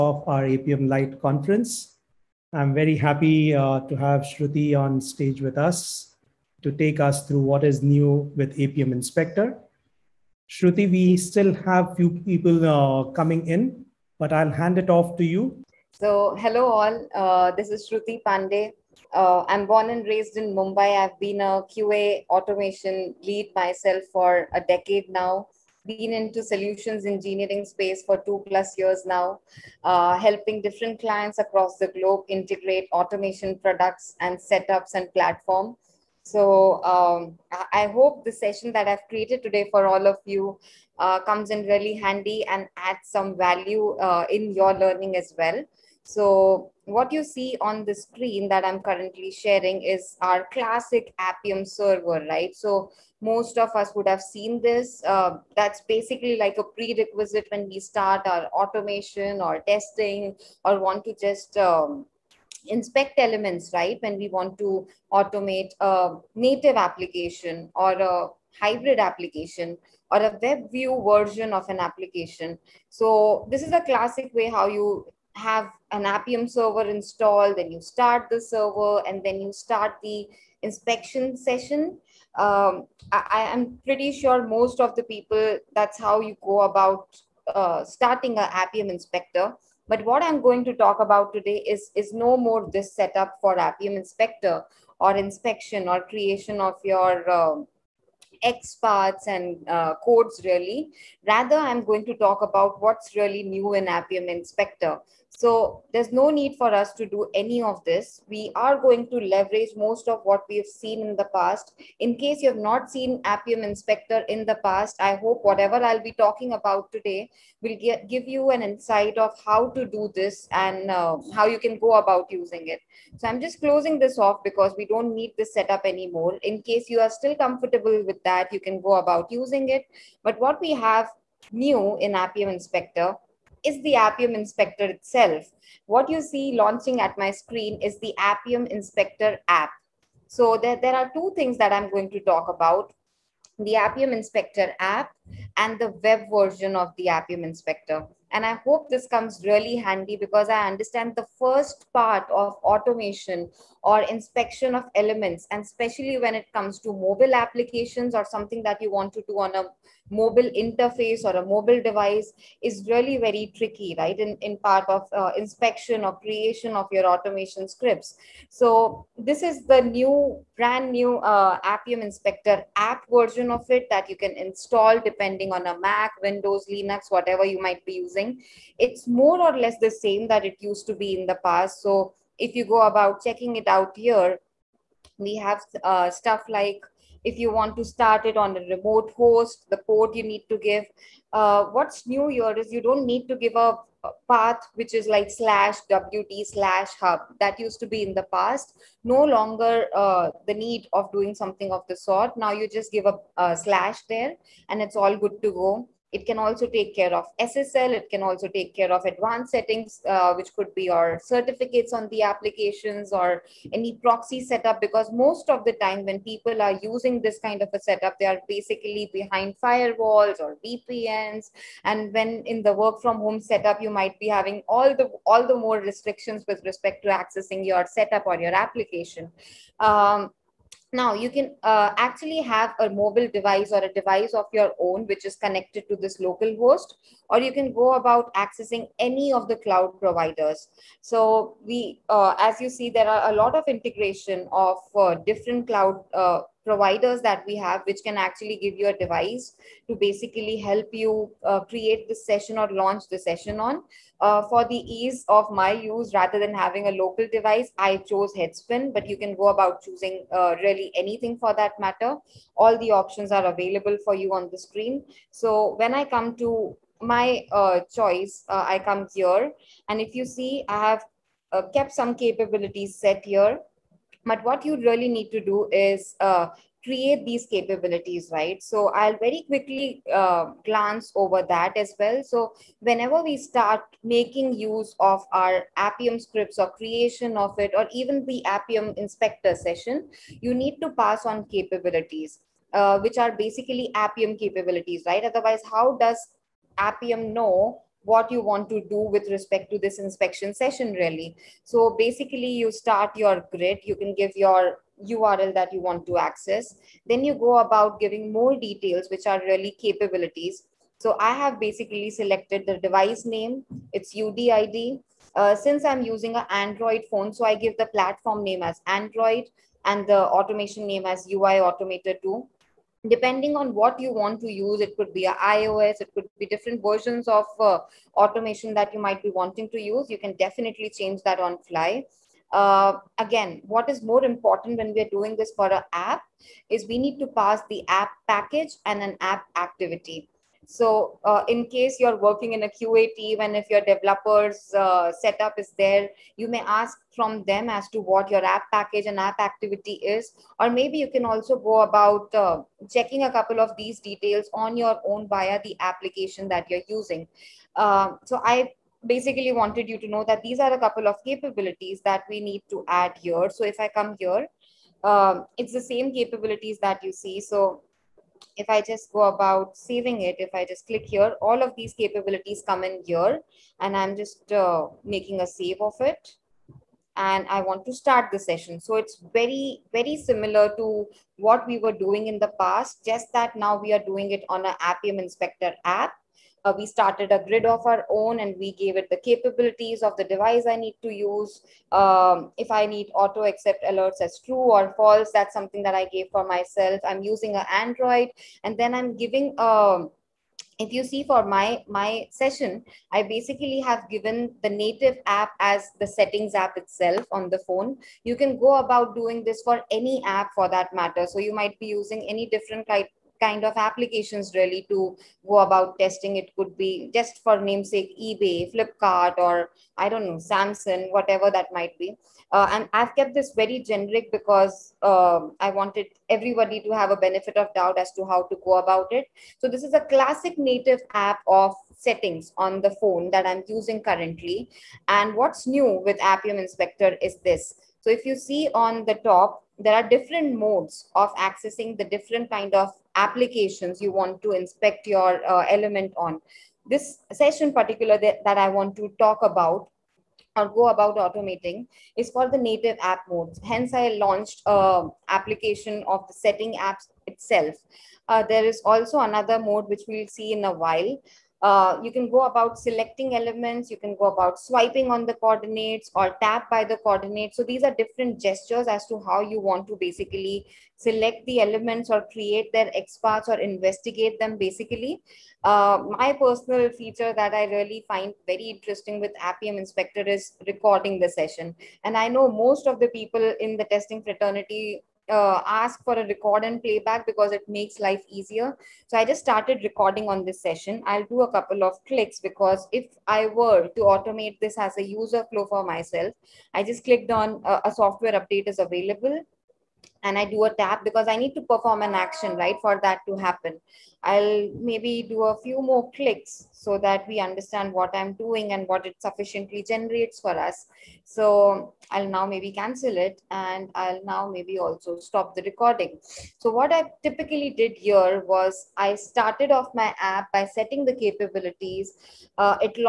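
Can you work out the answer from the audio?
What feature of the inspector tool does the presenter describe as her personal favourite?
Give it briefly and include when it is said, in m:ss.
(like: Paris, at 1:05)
recording the session, at 8:00.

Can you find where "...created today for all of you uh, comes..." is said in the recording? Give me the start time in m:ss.
0:39.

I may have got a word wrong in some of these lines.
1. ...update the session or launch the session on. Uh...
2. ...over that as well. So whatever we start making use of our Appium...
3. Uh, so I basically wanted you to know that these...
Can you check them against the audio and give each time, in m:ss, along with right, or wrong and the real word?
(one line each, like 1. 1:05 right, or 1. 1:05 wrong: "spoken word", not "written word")
1. 4:11 wrong: "create", not "update"
2. 4:41 wrong: "whenever", not "whatever"
3. 5:57 right.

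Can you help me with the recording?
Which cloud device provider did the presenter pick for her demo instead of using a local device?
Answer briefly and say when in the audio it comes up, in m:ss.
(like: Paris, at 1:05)
Headspin, at 4:18.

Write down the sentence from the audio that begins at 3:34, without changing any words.
Because most of the time, when people are using this kind of a setup, they are basically behind firewalls or VPNs.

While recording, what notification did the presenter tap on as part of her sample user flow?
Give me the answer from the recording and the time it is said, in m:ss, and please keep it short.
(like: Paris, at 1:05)
software update, at 8:17.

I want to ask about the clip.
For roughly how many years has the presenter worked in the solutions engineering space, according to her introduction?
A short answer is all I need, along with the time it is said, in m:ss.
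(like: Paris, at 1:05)
2 plus years, at 0:28.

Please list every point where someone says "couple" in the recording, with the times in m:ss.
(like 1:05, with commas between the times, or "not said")
5:53, 6:00, 8:11.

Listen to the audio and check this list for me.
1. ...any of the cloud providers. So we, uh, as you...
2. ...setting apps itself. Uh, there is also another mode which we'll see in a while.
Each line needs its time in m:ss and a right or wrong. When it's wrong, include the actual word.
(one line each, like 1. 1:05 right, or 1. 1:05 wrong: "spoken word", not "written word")
1. 3:58 right
2. 7:36 right.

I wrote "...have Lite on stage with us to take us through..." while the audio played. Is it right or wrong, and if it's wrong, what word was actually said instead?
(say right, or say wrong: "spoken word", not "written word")
wrong: "Shruti", not "Lite".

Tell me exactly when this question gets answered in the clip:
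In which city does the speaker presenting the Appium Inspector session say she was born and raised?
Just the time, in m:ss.
0:20.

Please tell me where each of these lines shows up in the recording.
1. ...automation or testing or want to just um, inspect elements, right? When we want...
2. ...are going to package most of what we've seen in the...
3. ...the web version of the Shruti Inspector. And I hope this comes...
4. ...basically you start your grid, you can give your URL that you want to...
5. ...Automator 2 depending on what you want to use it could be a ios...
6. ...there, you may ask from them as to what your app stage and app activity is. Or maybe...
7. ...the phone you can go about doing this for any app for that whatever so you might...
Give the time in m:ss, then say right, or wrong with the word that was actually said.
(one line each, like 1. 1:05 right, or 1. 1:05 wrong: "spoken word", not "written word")
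1. 0:58 right
2. 1:48 wrong: "leverage", not "package"
3. 2:25 wrong: "Appium", not "Shruti"
4. 5:01 right
5. 5:21 right
6. 5:45 wrong: "package", not "stage"
7. 6:47 wrong: "matter", not "whatever".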